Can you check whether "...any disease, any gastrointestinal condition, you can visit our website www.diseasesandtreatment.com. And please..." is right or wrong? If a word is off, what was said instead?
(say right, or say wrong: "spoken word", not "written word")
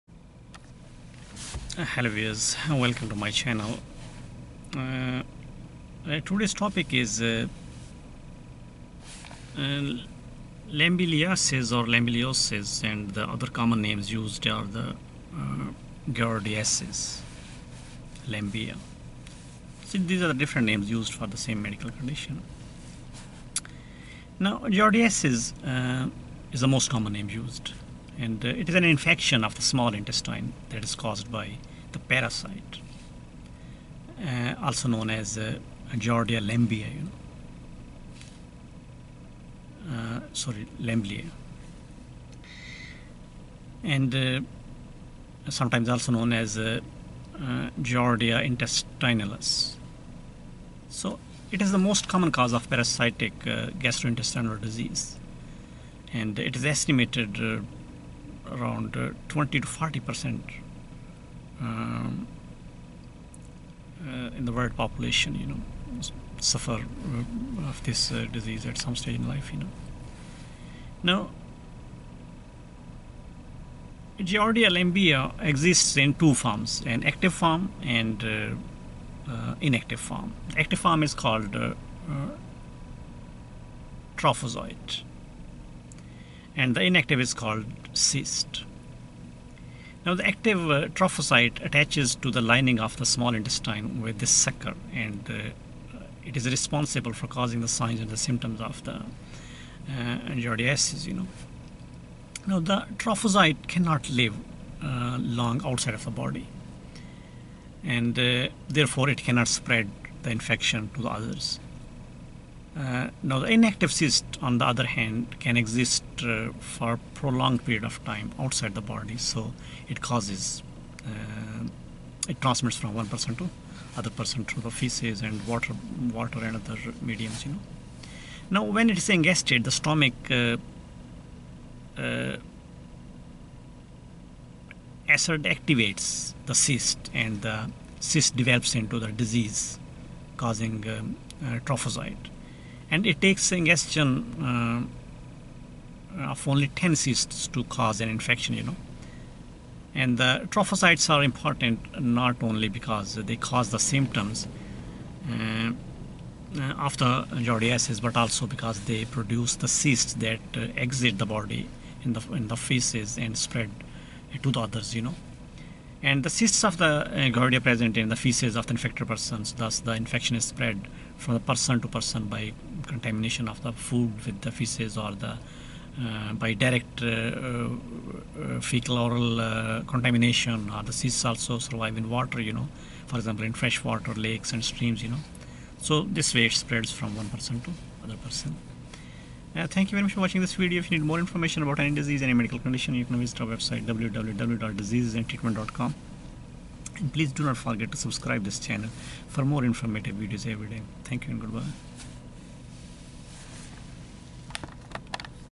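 wrong: "medical", not "gastrointestinal".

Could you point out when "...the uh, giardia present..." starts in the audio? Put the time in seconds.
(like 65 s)
166 s.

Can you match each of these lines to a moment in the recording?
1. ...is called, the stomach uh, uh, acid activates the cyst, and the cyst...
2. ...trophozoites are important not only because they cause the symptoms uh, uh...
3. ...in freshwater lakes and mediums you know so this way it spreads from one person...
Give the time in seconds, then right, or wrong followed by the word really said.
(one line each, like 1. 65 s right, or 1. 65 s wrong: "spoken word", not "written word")
1. 128 s wrong: "ingested", not "called"
2. 150 s right
3. 183 s wrong: "streams", not "mediums".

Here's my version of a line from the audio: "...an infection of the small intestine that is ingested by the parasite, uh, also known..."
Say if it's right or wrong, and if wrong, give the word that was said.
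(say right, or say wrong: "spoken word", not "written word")
wrong: "caused", not "ingested".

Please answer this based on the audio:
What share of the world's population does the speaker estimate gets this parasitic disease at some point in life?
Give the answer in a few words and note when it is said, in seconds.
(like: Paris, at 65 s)
20 to 40 percent, at 59 s.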